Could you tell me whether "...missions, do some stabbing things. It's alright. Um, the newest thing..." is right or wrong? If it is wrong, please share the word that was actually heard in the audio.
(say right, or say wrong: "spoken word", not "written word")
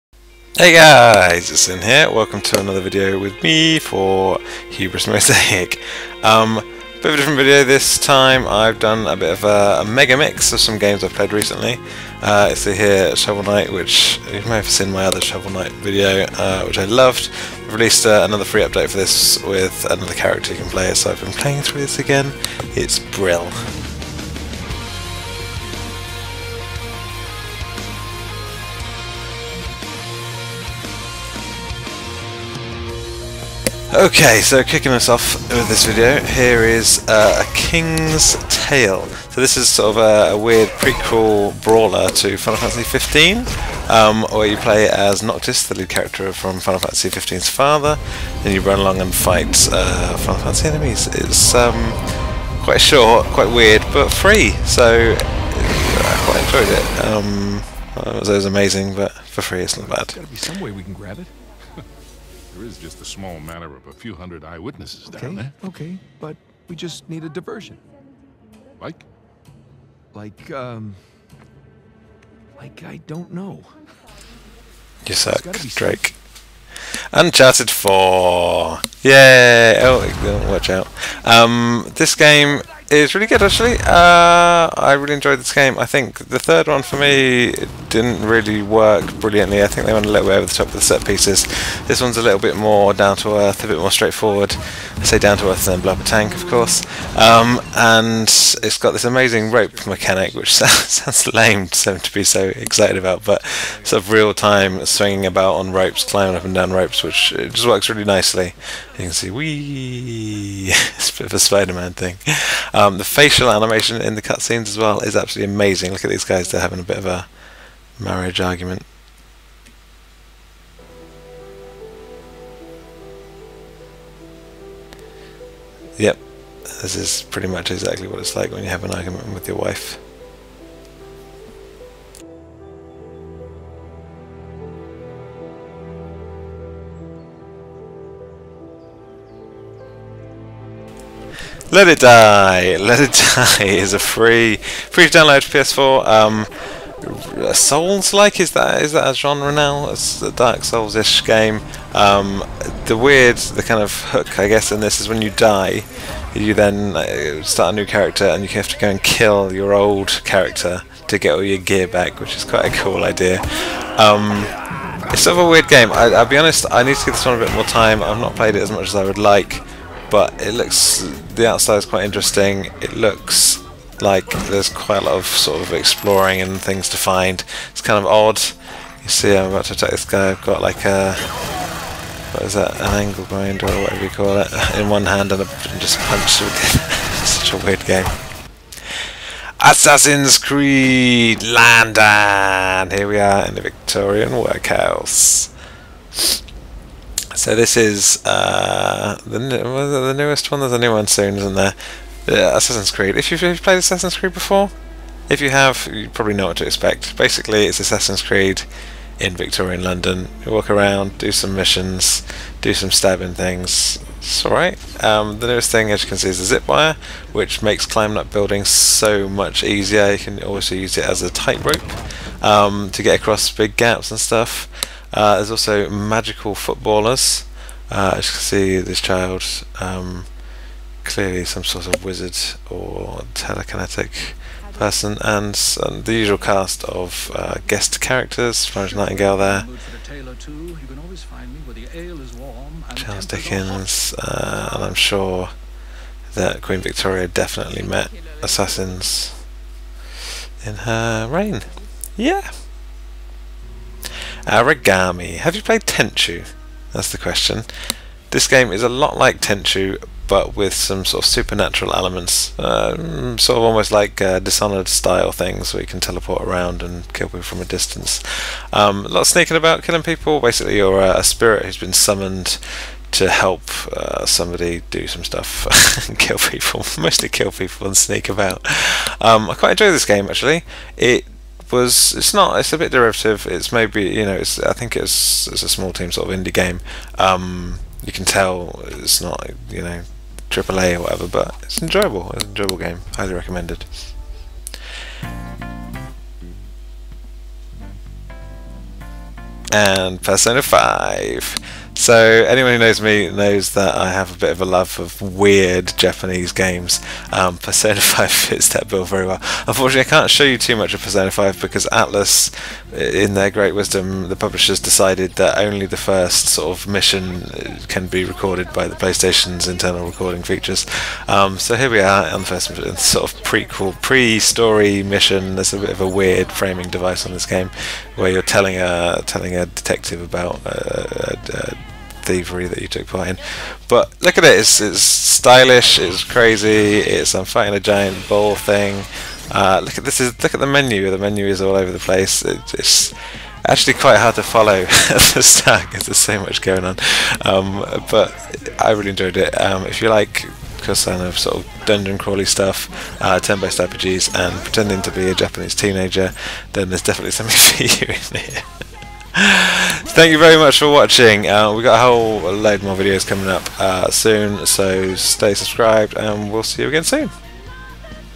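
right.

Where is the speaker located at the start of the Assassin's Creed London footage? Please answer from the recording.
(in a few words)
Victorian workhouse.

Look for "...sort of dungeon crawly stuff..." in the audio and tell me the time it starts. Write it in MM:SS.
05:51.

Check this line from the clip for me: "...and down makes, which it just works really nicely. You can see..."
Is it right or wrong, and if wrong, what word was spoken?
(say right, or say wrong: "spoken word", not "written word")
wrong: "ropes", not "makes".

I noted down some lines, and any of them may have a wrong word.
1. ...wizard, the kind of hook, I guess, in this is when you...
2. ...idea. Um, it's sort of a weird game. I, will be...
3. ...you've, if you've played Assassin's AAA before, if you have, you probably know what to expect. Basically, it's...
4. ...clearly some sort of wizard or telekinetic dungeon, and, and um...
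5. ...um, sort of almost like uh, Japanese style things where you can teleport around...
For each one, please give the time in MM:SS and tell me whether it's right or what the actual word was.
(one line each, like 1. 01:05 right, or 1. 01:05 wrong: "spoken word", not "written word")
1. 02:32 wrong: "weird", not "wizard"
2. 02:43 right
3. 03:23 wrong: "Creed", not "AAA"
4. 03:51 wrong: "person", not "dungeon"
5. 04:22 wrong: "Dishonored", not "Japanese".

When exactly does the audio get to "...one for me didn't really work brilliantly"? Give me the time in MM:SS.
01:26.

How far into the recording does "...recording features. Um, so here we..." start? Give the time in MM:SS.
05:20.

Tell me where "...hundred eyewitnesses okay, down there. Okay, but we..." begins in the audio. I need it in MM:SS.
01:04.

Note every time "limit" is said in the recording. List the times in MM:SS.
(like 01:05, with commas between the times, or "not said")
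not said.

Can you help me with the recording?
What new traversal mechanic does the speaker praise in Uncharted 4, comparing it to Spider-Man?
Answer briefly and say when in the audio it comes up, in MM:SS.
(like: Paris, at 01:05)
rope mechanic, at 01:39.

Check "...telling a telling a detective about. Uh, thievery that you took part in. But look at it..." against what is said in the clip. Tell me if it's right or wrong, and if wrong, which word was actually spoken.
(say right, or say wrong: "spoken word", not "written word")
right.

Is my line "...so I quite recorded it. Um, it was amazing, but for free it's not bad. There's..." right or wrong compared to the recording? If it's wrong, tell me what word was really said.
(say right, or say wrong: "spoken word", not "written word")
wrong: "enjoyed", not "recorded".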